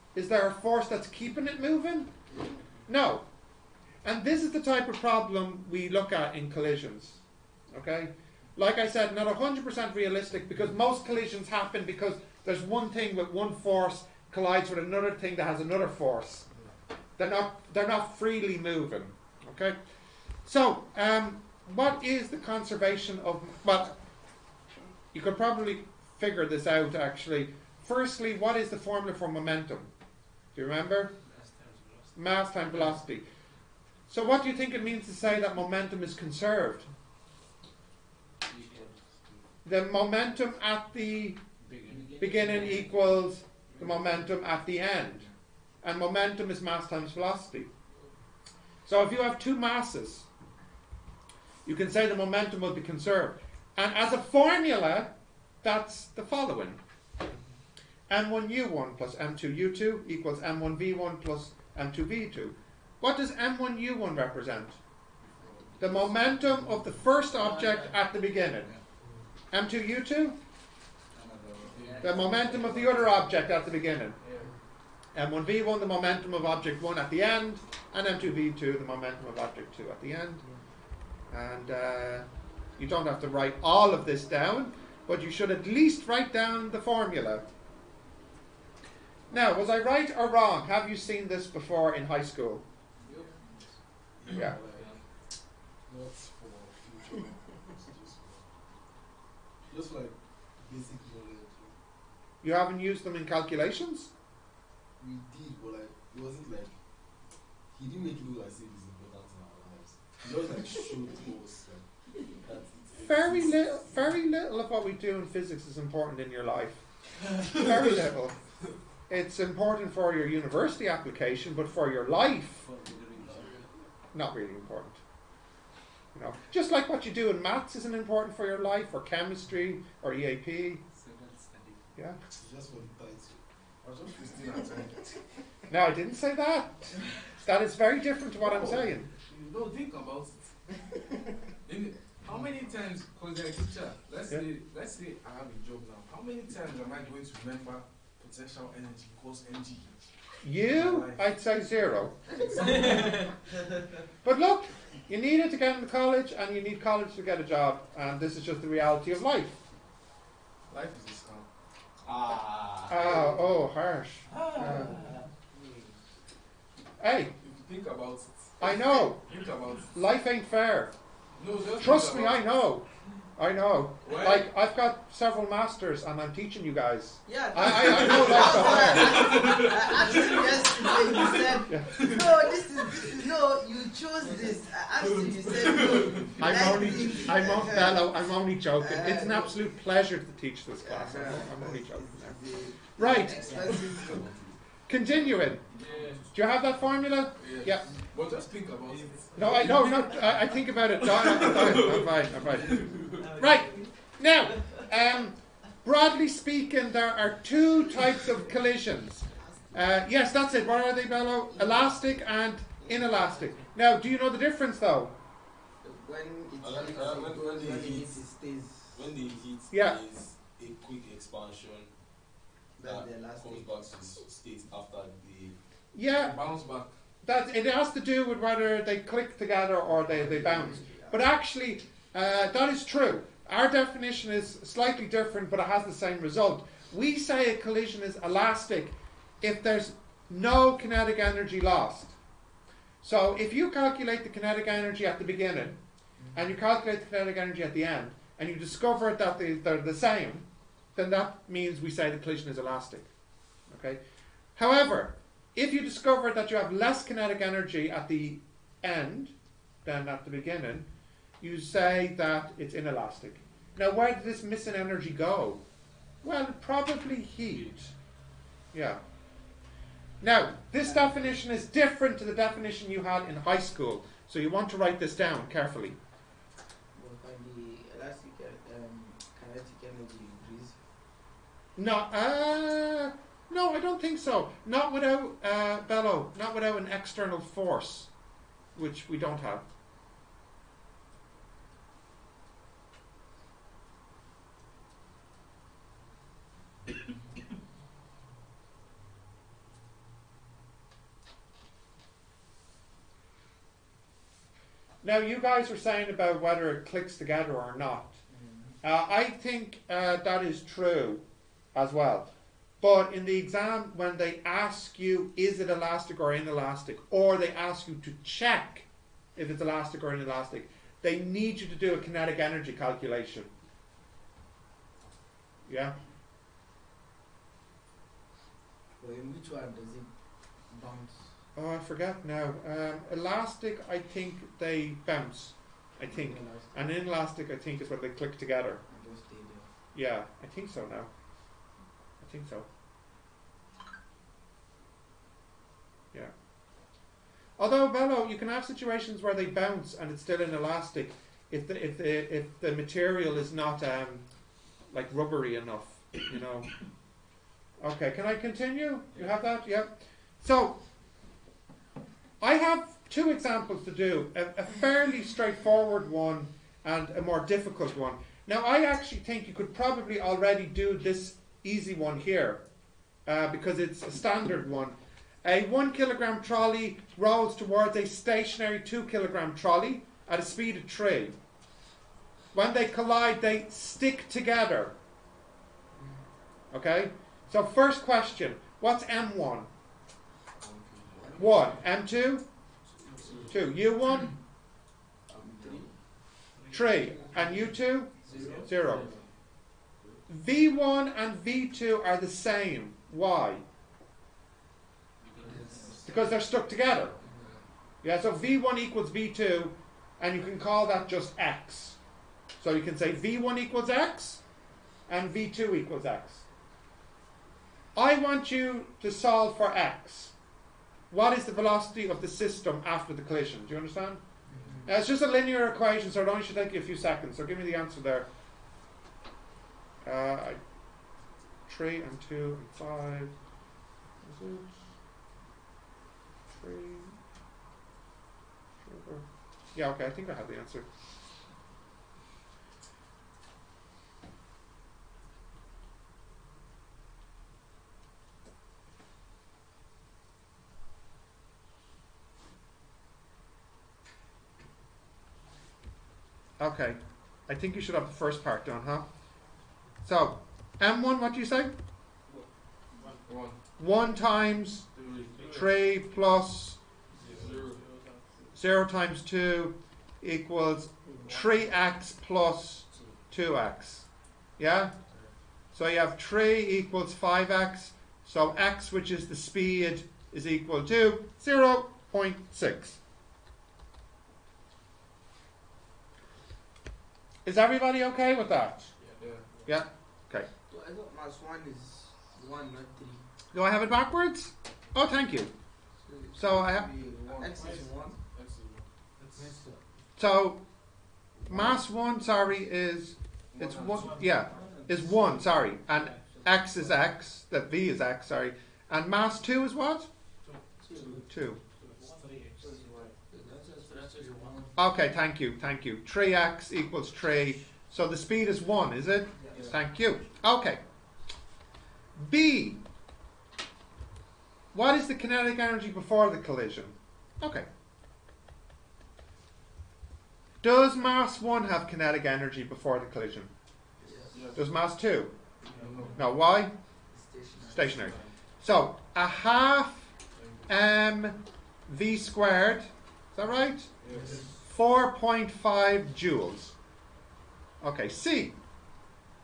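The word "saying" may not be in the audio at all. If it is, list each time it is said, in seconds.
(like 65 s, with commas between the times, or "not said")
138 s, 305 s.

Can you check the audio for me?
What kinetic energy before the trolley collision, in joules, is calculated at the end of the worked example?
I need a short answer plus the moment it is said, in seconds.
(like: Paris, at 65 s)
4.5 joules, at 544 s.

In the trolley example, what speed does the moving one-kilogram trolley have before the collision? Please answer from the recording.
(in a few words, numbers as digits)
3.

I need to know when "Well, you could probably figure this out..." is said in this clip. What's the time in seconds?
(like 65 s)
23 s.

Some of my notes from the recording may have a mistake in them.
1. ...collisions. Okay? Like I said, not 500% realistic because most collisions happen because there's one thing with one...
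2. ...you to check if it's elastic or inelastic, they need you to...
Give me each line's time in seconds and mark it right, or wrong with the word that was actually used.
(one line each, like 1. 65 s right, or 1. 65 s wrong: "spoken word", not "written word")
1. 6 s wrong: "100", not "500"
2. 317 s right.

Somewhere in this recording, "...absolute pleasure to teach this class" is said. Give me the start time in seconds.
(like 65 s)
189 s.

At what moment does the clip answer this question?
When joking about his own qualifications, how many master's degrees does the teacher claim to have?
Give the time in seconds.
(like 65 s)
175 s.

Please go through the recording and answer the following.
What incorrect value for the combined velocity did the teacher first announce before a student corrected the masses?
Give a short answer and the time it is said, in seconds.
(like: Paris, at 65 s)
0.6, at 481 s.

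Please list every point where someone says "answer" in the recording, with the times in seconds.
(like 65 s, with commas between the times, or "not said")
427 s, 440 s.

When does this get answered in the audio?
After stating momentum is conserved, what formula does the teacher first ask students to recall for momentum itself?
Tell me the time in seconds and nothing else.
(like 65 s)
32 s.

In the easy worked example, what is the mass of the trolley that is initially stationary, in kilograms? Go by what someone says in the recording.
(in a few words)
2 kilograms.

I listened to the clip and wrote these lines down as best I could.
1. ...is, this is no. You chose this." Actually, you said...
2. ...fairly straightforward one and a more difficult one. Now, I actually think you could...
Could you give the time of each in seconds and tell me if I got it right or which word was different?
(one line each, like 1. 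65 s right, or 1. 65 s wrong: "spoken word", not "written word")
1. 182 s right
2. 364 s right.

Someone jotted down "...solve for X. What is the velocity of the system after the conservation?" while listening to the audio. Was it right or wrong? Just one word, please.
wrong.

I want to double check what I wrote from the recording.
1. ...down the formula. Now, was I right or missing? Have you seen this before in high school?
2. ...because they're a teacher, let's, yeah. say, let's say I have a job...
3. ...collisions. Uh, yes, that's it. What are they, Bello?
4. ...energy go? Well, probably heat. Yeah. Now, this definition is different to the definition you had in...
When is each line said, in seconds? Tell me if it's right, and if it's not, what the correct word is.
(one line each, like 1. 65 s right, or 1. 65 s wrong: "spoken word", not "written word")
1. 86 s wrong: "wrong", not "missing"
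2. 143 s right
3. 208 s right
4. 264 s right.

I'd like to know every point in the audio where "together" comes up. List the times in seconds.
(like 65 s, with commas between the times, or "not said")
229 s, 307 s, 338 s, 384 s, 406 s.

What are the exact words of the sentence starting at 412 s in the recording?
So you can say V1 equals X, and V2 equals X.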